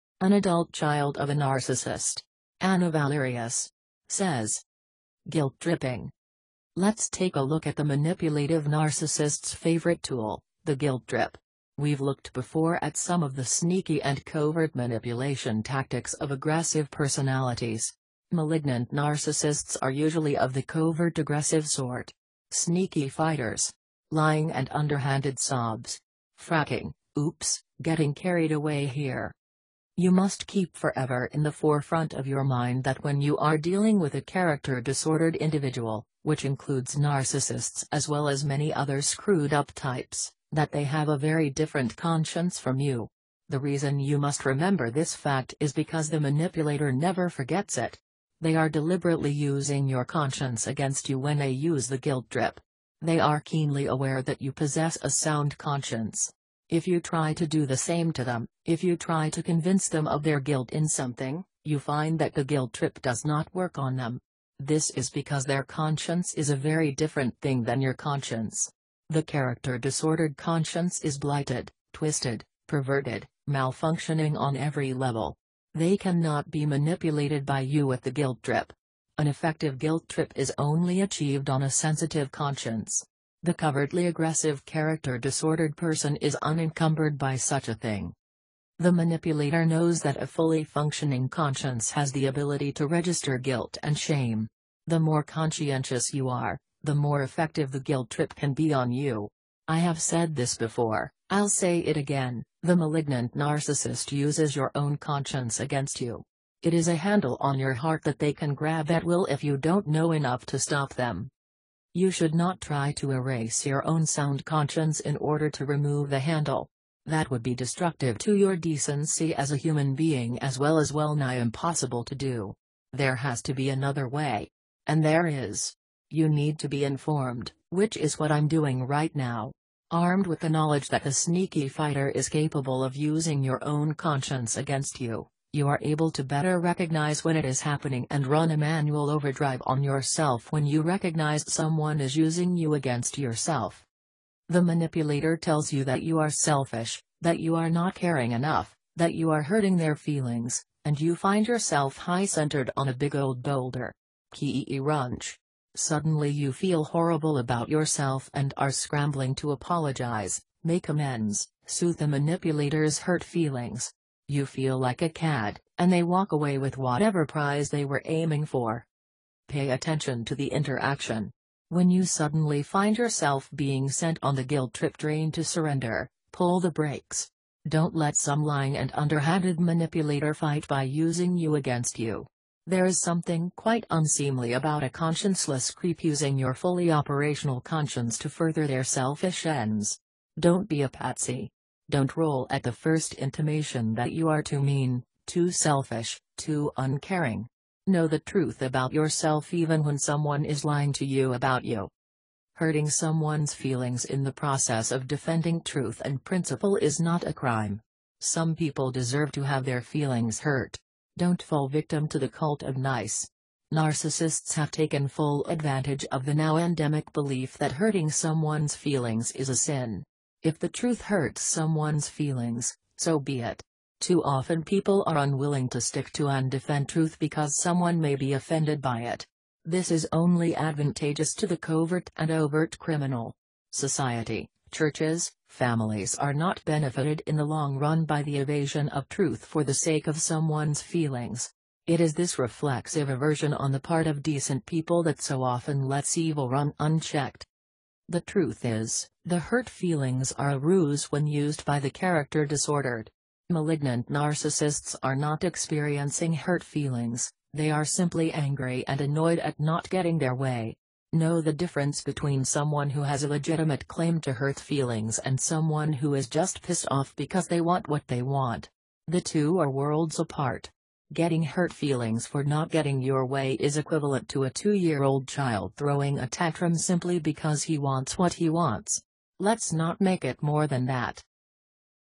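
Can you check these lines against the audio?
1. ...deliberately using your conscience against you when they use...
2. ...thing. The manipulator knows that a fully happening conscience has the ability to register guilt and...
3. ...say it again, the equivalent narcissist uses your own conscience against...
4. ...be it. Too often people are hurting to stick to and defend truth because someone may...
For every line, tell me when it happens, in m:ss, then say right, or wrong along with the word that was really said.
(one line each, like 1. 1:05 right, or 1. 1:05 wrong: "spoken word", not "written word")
1. 0:48 right
2. 1:27 wrong: "functioning", not "happening"
3. 1:41 wrong: "malignant", not "equivalent"
4. 3:43 wrong: "unwilling", not "hurting".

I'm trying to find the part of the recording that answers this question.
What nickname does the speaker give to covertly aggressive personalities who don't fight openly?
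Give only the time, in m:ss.
0:22.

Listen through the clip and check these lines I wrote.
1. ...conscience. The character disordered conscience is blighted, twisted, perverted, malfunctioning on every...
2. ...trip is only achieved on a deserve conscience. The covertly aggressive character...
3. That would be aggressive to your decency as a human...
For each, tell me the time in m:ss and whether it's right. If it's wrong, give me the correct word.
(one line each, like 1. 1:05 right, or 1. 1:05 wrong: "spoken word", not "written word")
1. 1:07 right
2. 1:20 wrong: "sensitive", not "deserve"
3. 1:57 wrong: "destructive", not "aggressive".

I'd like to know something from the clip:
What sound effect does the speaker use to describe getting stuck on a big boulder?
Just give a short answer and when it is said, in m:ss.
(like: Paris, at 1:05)
Kee runch, at 2:34.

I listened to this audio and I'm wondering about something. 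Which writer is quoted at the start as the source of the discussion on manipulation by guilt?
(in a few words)
Anna Valerious.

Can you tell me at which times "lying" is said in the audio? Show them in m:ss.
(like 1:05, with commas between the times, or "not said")
0:24, 2:58, 3:20.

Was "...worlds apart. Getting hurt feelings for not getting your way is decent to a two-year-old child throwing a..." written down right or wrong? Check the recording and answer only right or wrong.
wrong.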